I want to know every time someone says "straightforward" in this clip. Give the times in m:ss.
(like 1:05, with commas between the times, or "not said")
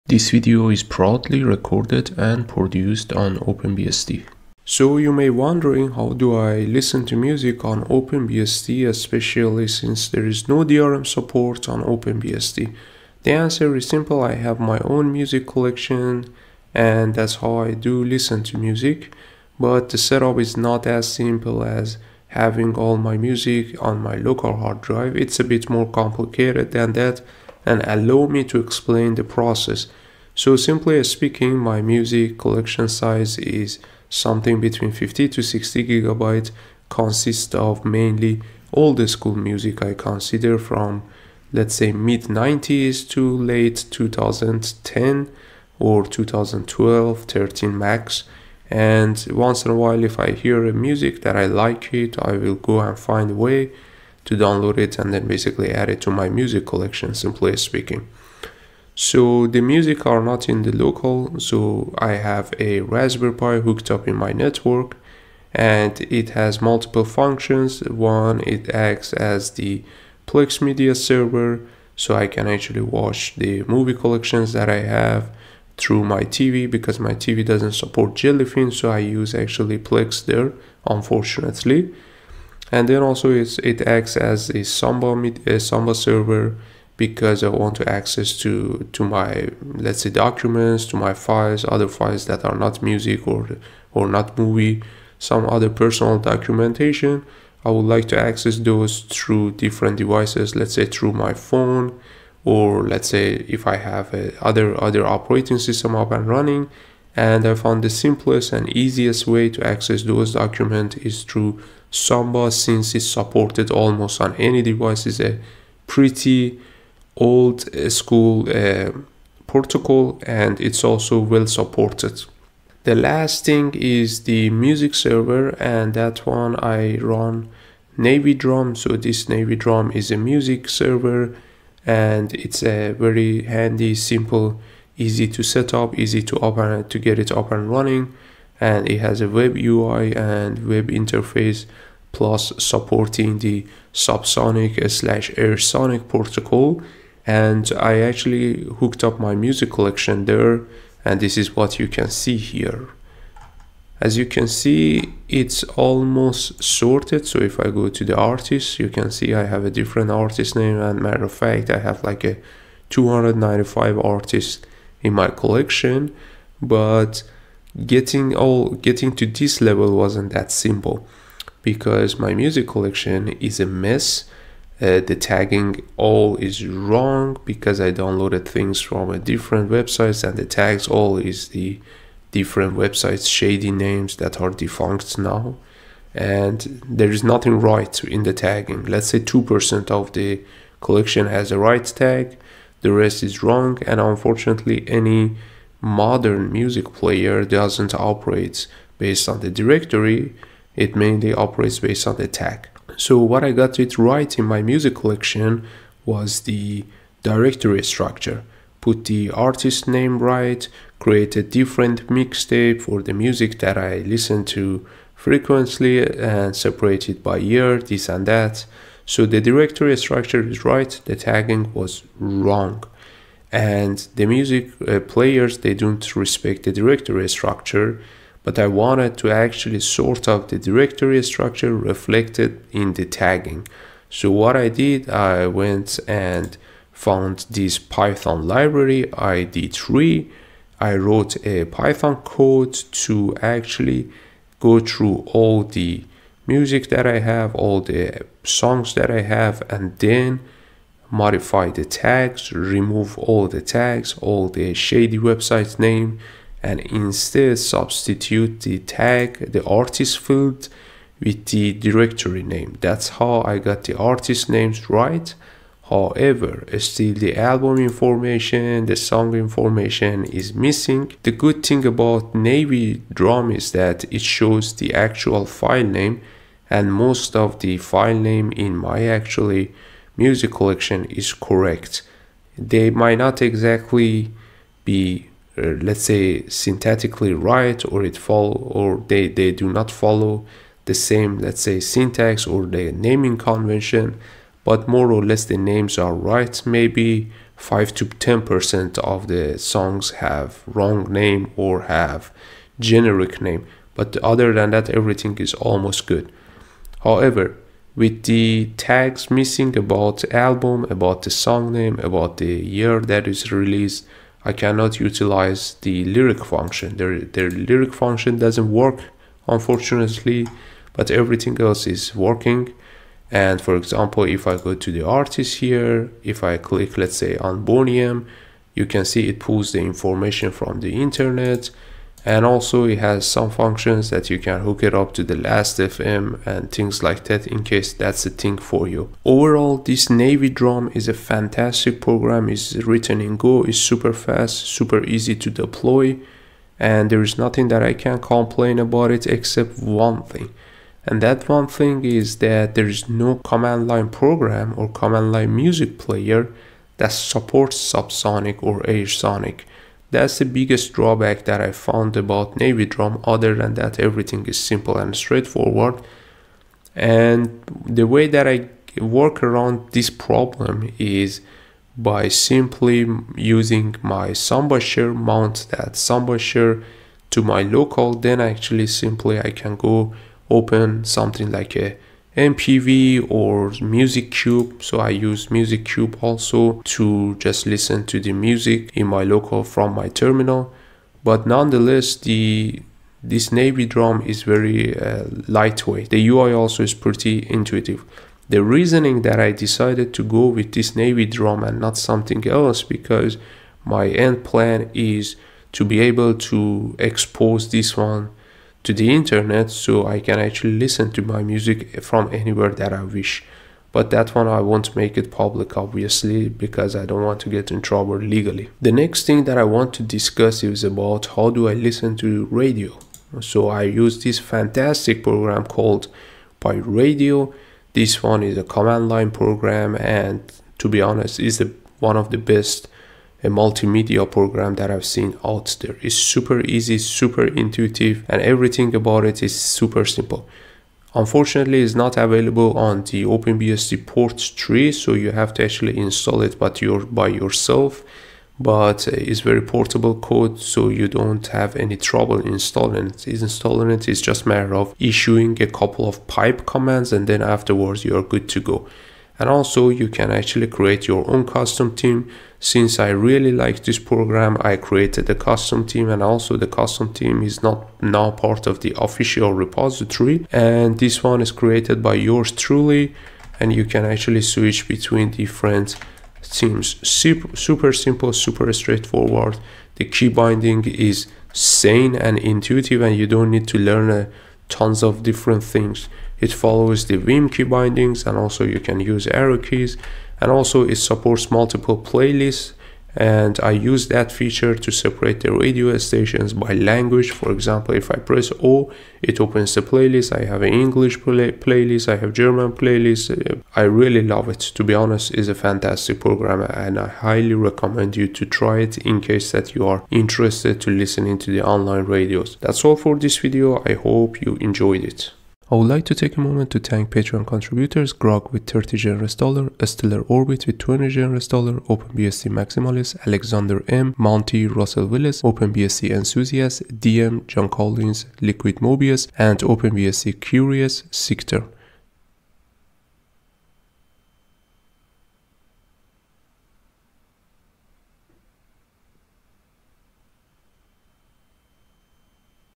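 6:05, 7:58.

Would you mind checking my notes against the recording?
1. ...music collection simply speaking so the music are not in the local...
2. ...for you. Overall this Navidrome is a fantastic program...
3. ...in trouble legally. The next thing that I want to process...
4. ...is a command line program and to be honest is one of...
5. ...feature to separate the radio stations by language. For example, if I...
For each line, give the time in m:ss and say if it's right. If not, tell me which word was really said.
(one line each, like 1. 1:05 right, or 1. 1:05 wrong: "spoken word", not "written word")
1. 0:56 right
2. 5:38 right
3. 6:57 wrong: "discuss", not "process"
4. 7:08 right
5. 8:14 right.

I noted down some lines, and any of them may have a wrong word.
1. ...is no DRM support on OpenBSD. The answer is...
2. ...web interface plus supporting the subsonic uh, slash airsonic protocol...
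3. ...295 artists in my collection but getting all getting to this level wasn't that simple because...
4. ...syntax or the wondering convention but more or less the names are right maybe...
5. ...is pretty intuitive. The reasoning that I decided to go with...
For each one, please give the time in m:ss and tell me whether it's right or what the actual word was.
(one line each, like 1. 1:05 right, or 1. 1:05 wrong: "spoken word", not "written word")
1. 0:10 right
2. 2:20 right
3. 2:42 right
4. 4:51 wrong: "naming", not "wondering"
5. 6:36 right.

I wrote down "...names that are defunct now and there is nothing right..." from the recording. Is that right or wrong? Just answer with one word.
right.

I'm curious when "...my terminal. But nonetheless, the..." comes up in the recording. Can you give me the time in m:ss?
6:29.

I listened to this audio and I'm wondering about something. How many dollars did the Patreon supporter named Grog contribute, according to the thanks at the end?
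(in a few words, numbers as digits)
30.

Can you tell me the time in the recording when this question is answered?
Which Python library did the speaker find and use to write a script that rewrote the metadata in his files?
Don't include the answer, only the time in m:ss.
3:59.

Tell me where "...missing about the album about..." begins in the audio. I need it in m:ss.
5:09.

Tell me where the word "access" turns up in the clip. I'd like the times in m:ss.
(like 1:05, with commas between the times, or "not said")
1:27, 1:38, 1:49.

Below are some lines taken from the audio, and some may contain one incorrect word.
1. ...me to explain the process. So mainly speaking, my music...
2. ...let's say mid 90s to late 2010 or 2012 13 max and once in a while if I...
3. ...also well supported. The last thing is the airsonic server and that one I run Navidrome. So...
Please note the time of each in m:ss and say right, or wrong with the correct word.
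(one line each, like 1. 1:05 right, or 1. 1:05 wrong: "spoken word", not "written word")
1. 0:28 wrong: "simply", not "mainly"
2. 0:41 right
3. 2:00 wrong: "music", not "airsonic".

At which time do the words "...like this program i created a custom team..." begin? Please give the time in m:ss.
7:43.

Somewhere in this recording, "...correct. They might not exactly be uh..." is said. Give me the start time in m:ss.
4:41.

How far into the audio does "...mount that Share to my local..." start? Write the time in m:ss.
6:15.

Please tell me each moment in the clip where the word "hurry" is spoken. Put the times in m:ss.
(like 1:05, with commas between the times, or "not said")
not said.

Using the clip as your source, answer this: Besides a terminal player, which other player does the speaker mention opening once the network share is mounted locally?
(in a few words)
MPV.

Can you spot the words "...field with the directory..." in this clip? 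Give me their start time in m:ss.
4:20.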